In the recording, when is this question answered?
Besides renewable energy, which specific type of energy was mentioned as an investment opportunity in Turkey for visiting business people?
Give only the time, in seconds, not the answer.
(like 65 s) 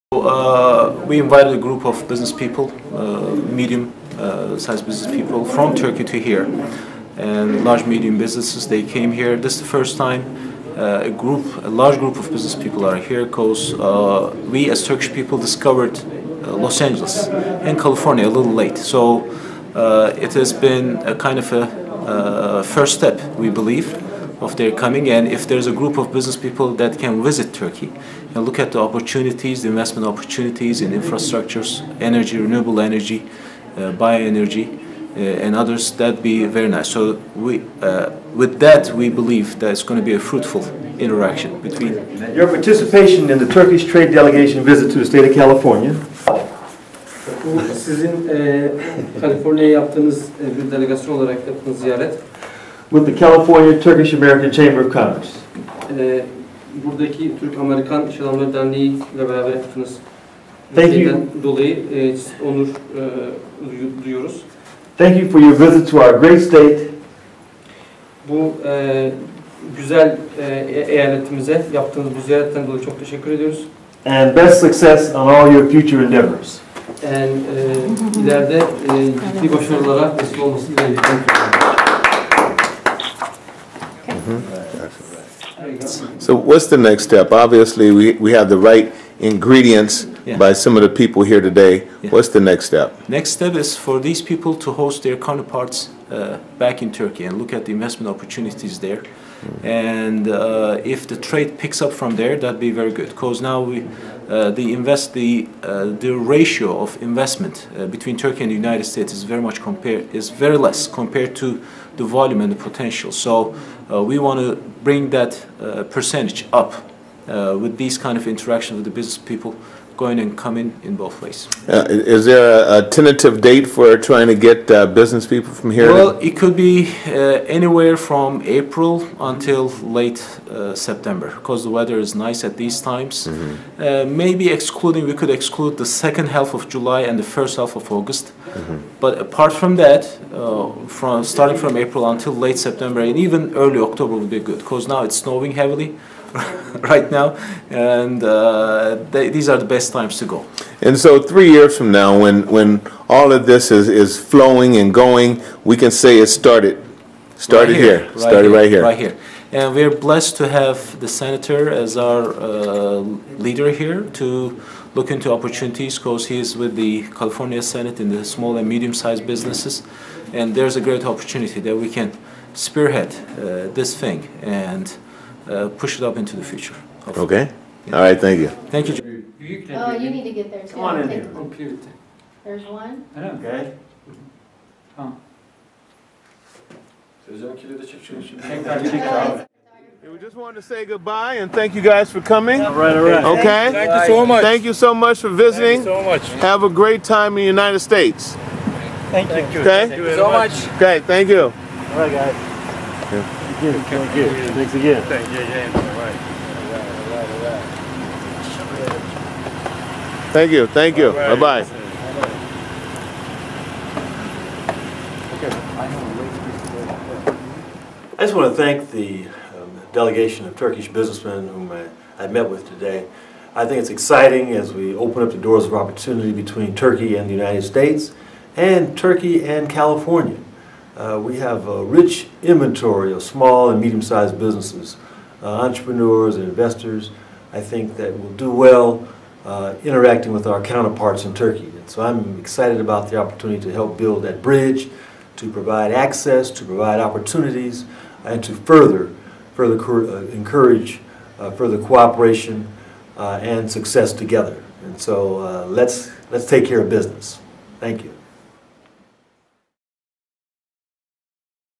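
33 s.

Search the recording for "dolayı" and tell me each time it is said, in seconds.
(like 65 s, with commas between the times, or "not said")
61 s, 72 s.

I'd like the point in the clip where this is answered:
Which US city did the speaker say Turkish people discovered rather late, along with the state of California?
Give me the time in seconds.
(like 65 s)
16 s.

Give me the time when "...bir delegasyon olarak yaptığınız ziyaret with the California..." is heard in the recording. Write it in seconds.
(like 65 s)
50 s.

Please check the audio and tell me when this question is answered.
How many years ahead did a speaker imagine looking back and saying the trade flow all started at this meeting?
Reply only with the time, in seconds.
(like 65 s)
151 s.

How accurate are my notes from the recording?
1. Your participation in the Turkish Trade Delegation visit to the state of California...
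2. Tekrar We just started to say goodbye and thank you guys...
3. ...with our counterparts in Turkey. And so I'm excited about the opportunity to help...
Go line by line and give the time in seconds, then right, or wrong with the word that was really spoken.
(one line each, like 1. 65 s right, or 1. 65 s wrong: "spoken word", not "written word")
1. 42 s right
2. 187 s wrong: "wanted", not "started"
3. 240 s right.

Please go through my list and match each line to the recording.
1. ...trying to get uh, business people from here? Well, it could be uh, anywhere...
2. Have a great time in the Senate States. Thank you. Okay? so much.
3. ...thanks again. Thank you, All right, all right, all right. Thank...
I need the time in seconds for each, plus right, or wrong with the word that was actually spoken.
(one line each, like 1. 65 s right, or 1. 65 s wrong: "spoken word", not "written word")
1. 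124 s right
2. 196 s wrong: "United", not "Senate"
3. 204 s right.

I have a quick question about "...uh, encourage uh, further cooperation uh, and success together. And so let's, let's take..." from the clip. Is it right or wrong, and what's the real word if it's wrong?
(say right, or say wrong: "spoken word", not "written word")
right.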